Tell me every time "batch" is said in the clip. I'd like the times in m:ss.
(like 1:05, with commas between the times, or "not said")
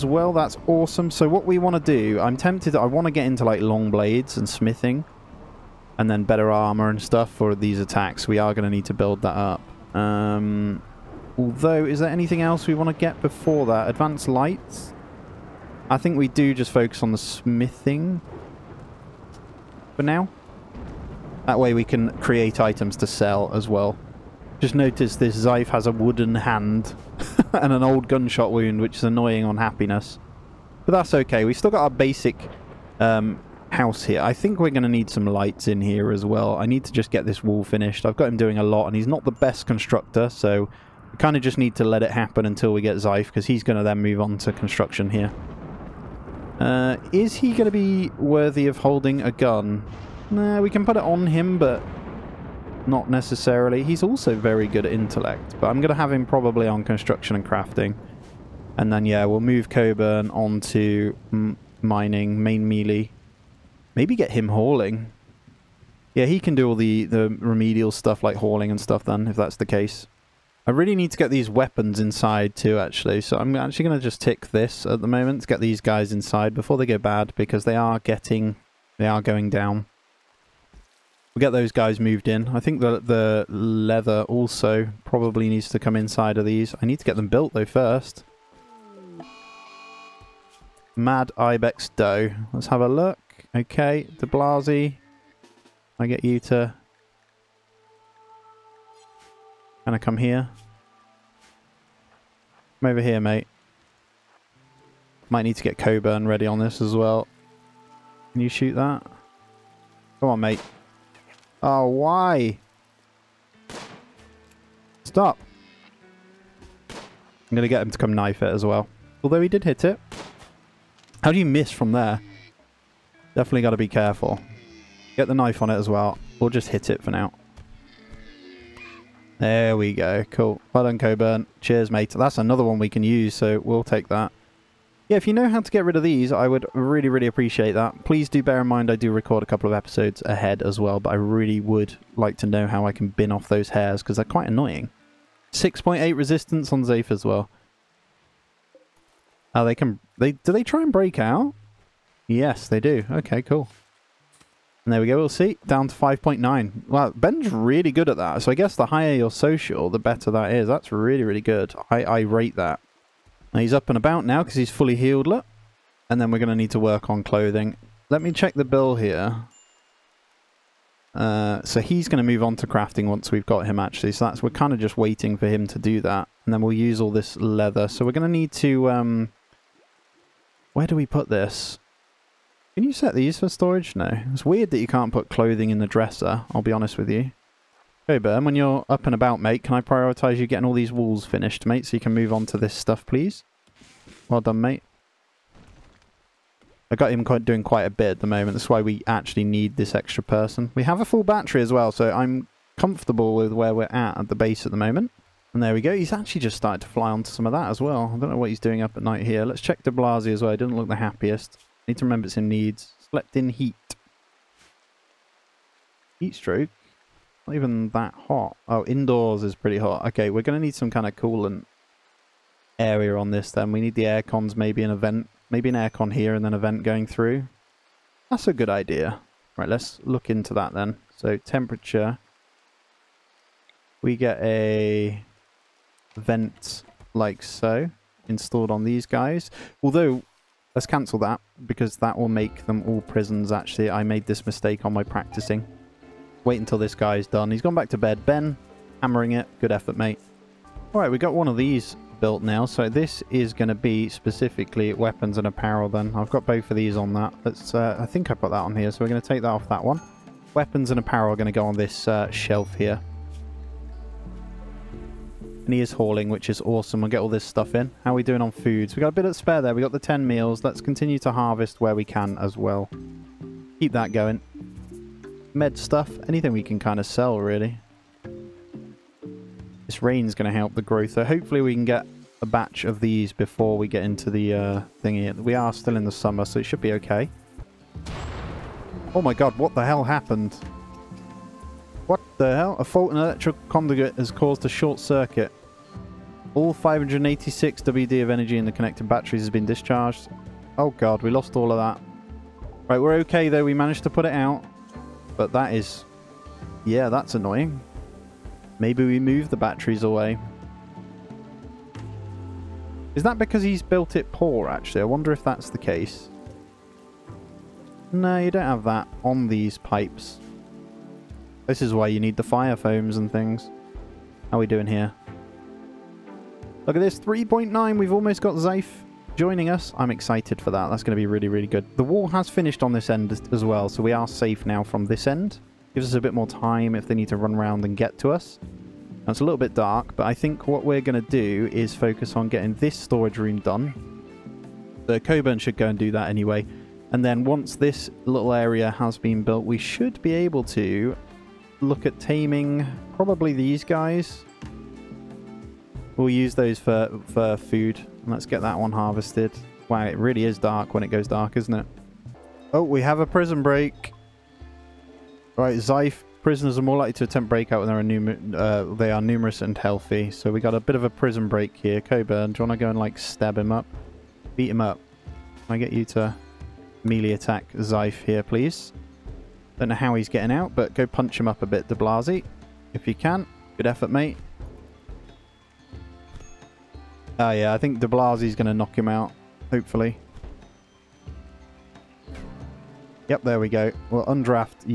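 4:42.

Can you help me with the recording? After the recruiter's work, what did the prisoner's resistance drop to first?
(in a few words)
5.9.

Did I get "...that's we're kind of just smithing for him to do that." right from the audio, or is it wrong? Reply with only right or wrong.
wrong.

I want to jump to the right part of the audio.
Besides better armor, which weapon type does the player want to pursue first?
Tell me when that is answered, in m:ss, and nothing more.
0:03.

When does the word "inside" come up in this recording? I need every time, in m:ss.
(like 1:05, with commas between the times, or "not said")
1:12, 1:16, 1:25.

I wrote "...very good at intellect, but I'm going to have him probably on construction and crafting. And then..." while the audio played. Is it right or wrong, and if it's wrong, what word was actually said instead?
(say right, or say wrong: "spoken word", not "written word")
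right.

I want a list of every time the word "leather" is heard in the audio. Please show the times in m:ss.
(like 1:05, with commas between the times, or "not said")
1:23, 2:57.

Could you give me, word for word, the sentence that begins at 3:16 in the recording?
I got him quite, doing quite a bit at the moment.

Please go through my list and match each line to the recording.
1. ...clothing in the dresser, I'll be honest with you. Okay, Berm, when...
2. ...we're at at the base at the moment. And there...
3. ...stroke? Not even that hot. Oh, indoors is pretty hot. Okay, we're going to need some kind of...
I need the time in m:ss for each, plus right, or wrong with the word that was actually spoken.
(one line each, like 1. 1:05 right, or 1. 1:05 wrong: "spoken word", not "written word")
1. 3:05 right
2. 3:23 right
3. 3:36 right.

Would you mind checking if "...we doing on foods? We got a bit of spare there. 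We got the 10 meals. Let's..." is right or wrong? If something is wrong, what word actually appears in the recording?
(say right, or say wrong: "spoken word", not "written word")
right.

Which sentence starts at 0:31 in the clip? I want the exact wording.
We've still got our basic um, house here.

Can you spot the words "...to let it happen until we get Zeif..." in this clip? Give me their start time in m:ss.
0:41.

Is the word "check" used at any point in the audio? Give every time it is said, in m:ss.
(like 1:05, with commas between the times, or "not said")
2:48, 3:29.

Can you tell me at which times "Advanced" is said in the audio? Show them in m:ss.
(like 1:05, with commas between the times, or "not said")
0:13.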